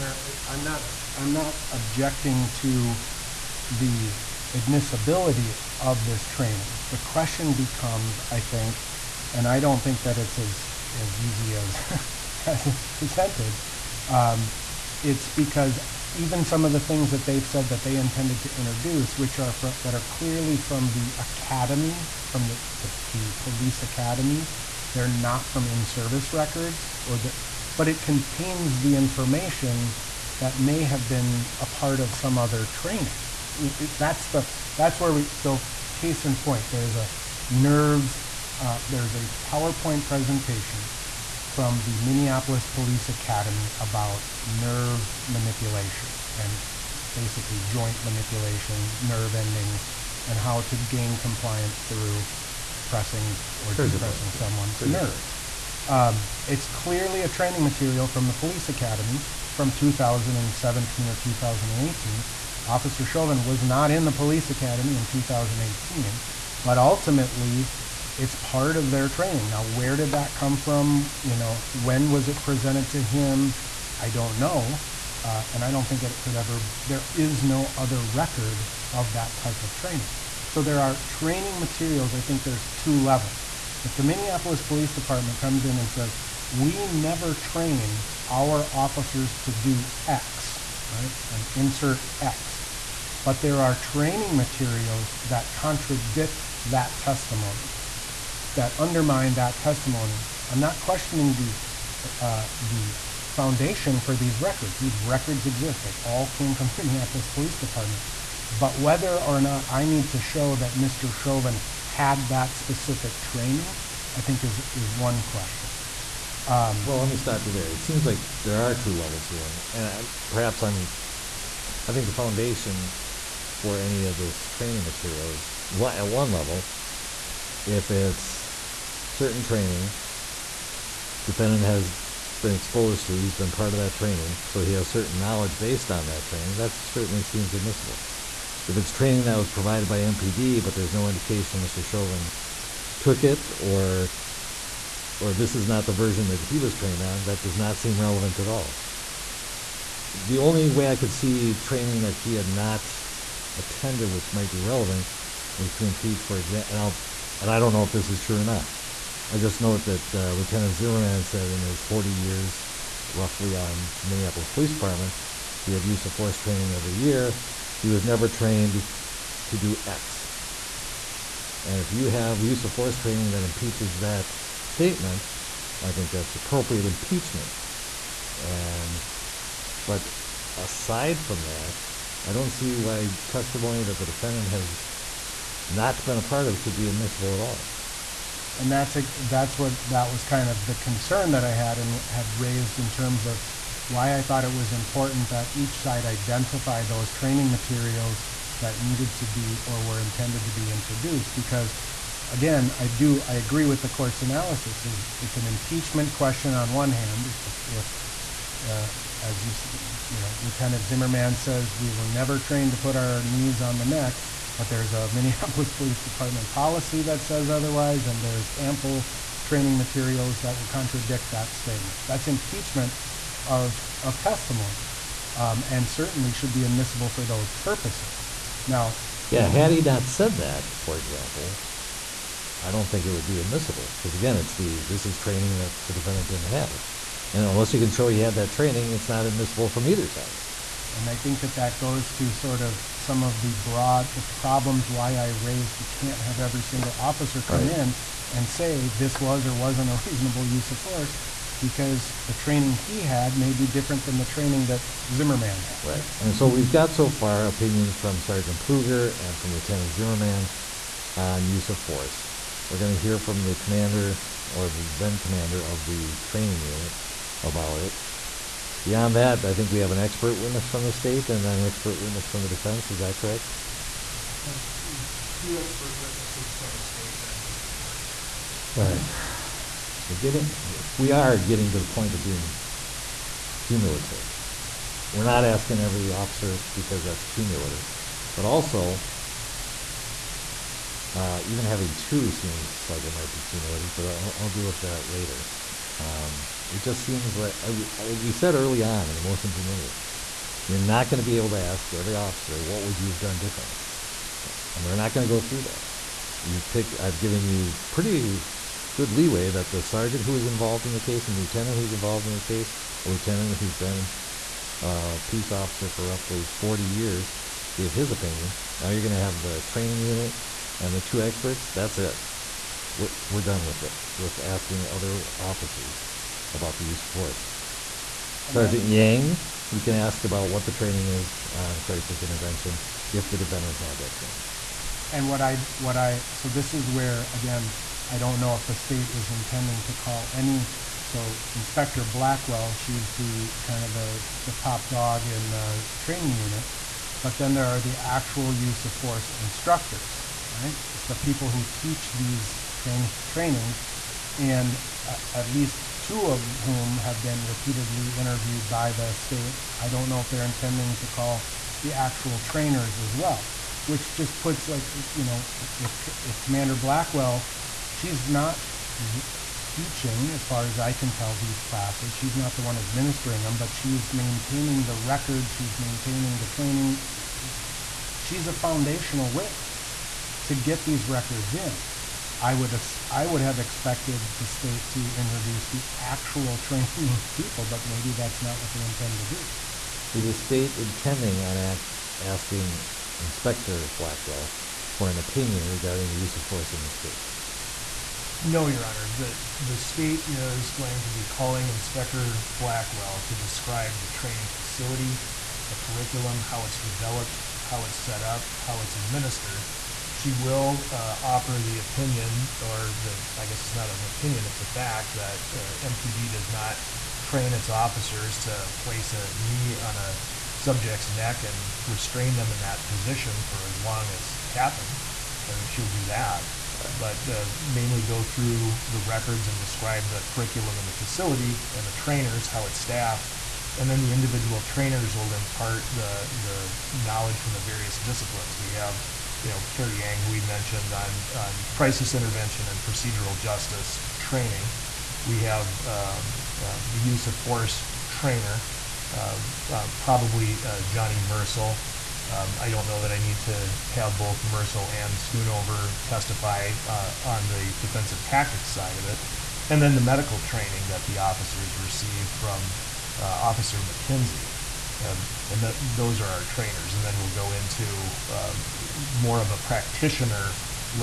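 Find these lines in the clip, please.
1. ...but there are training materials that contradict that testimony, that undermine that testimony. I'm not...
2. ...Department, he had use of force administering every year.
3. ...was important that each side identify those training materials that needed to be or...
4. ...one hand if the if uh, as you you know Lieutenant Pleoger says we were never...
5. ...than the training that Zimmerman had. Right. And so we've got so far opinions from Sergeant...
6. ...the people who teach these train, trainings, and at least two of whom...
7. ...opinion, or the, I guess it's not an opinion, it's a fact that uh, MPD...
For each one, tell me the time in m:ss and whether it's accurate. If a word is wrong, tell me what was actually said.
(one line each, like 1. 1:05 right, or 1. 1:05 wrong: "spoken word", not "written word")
1. 1:33 right
2. 2:44 wrong: "training", not "administering"
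3. 3:14 right
4. 3:26 wrong: "Zimmerman", not "Pleoger"
5. 4:14 right
6. 5:51 right
7. 6:51 right.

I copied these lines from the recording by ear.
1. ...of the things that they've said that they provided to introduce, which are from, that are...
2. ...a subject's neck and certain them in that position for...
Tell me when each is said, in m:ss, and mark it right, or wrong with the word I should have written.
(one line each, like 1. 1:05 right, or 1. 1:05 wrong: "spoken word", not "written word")
1. 0:16 wrong: "intended", not "provided"
2. 6:59 wrong: "restrain", not "certain".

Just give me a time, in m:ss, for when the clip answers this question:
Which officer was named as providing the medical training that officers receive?
7:43.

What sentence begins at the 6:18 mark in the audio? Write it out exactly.
She's a foundational witness to get these records in.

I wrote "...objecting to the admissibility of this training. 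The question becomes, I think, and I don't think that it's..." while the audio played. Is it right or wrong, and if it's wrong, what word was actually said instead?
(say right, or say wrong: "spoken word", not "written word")
right.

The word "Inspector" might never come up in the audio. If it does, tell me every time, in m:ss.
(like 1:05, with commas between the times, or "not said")
5:41, 6:33, 6:41.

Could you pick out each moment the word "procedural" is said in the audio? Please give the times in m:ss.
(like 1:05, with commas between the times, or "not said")
7:22.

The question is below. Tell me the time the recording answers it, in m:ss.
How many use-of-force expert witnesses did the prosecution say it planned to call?
4:35.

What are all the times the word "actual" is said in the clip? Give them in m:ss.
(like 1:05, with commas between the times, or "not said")
5:47, 6:01, 6:25.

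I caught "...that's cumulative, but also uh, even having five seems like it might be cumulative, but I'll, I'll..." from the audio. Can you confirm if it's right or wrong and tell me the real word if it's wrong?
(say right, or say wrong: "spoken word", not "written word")
wrong: "two", not "five".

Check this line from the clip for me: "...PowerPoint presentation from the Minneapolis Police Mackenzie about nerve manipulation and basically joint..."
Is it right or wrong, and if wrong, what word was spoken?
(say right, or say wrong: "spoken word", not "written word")
wrong: "Academy", not "Mackenzie".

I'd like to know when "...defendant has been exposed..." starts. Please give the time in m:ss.
2:11.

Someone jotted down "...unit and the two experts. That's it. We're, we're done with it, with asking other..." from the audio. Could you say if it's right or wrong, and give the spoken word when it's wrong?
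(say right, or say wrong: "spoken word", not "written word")
right.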